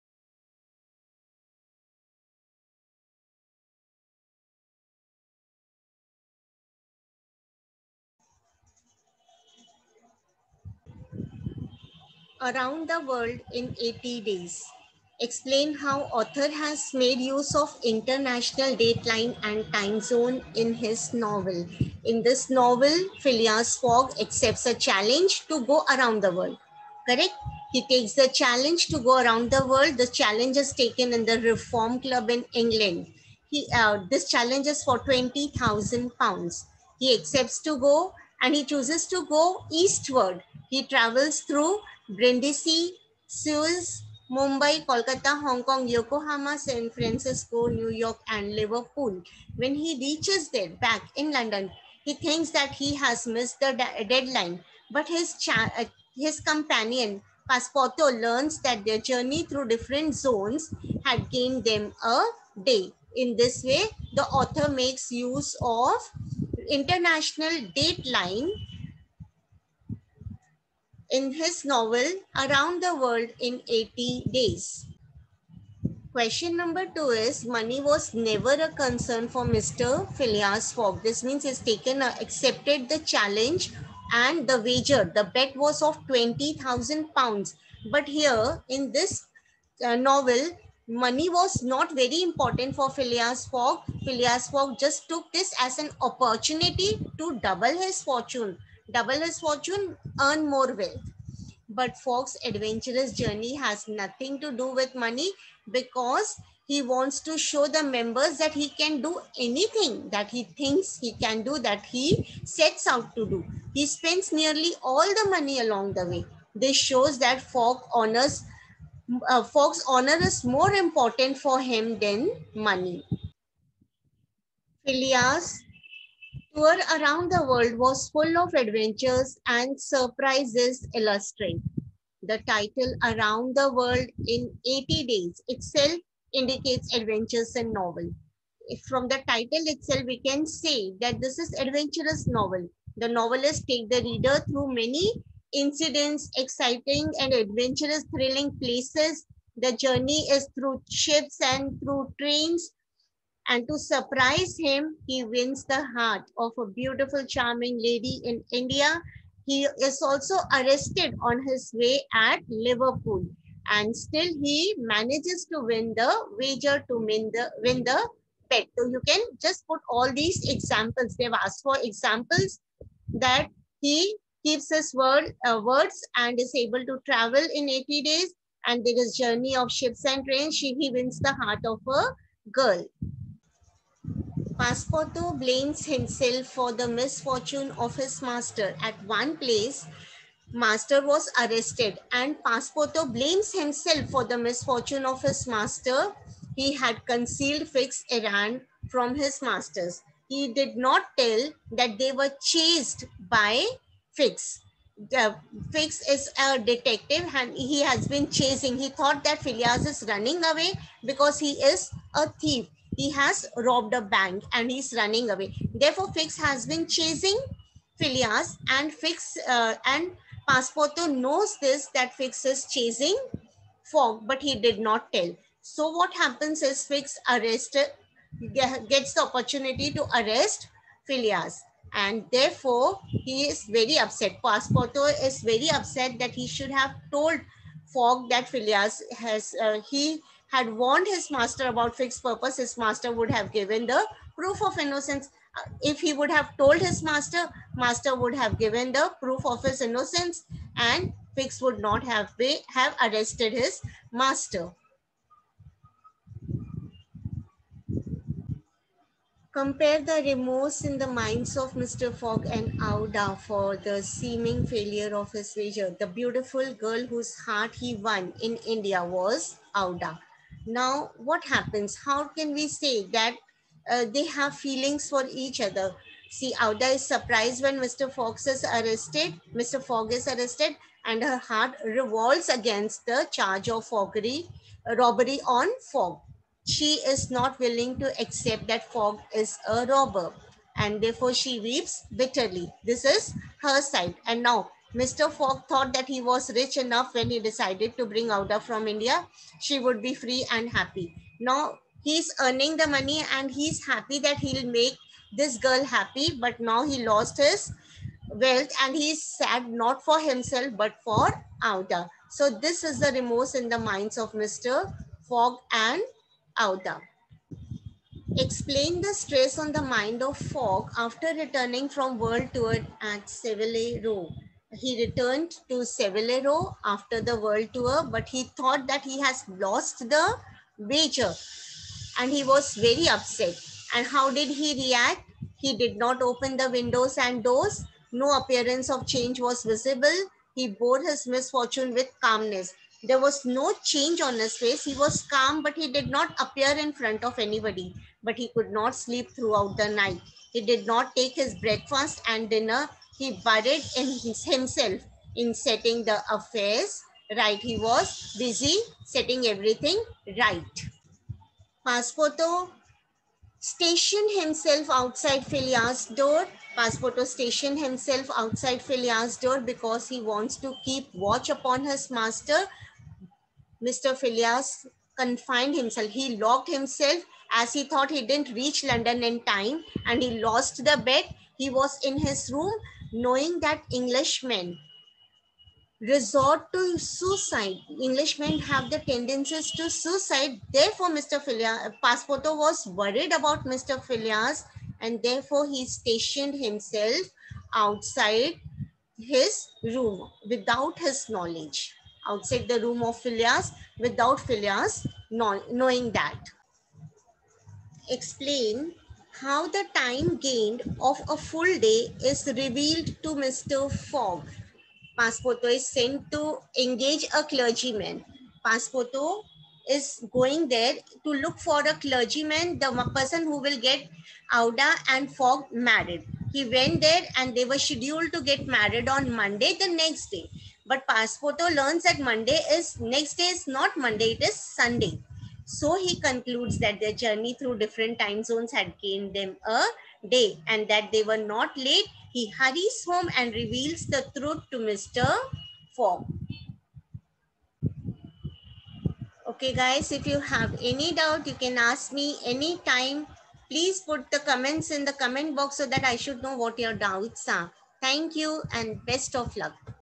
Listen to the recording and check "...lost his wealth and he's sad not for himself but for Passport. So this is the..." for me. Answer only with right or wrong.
wrong.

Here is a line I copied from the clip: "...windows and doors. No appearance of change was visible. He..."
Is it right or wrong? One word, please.
right.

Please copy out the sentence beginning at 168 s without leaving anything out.
So you can just put all these examples.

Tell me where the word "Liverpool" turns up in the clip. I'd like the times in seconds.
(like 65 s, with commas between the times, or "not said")
48 s, 162 s.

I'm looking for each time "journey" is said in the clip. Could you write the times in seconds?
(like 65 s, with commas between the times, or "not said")
58 s, 103 s, 149 s, 179 s, 437 s.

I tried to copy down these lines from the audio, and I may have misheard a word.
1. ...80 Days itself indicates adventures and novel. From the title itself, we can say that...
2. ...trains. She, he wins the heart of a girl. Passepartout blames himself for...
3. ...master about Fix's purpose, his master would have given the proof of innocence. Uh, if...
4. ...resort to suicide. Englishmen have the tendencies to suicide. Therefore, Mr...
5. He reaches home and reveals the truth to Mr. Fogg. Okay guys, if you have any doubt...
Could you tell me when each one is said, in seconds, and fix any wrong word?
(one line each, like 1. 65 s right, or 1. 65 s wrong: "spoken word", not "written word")
1. 134 s right
2. 180 s right
3. 241 s right
4. 385 s right
5. 442 s wrong: "hurries", not "reaches".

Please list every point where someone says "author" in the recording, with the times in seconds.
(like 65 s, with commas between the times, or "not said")
16 s, 64 s.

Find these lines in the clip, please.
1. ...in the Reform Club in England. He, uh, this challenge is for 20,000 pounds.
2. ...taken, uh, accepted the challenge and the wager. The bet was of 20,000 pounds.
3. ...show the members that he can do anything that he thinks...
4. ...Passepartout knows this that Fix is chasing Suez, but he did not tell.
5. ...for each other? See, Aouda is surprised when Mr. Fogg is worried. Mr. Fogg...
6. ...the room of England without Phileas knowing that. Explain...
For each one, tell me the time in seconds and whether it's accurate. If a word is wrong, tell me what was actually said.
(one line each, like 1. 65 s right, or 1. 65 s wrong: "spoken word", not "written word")
1. 31 s right
2. 81 s right
3. 107 s right
4. 220 s wrong: "Fogg", not "Suez"
5. 275 s wrong: "arrested", not "worried"
6. 402 s wrong: "Phileas", not "England".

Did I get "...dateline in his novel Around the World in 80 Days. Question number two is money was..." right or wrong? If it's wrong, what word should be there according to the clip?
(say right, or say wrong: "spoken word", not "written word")
right.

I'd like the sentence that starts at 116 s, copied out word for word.
This shows that Fogg's honors uh, Fox honor is more important for him than money.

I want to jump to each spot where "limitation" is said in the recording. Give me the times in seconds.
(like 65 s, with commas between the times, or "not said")
not said.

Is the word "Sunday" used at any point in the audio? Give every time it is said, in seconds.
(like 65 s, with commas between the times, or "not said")
434 s.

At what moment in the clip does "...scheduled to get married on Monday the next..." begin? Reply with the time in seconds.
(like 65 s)
427 s.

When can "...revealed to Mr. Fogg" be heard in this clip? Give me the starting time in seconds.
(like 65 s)
412 s.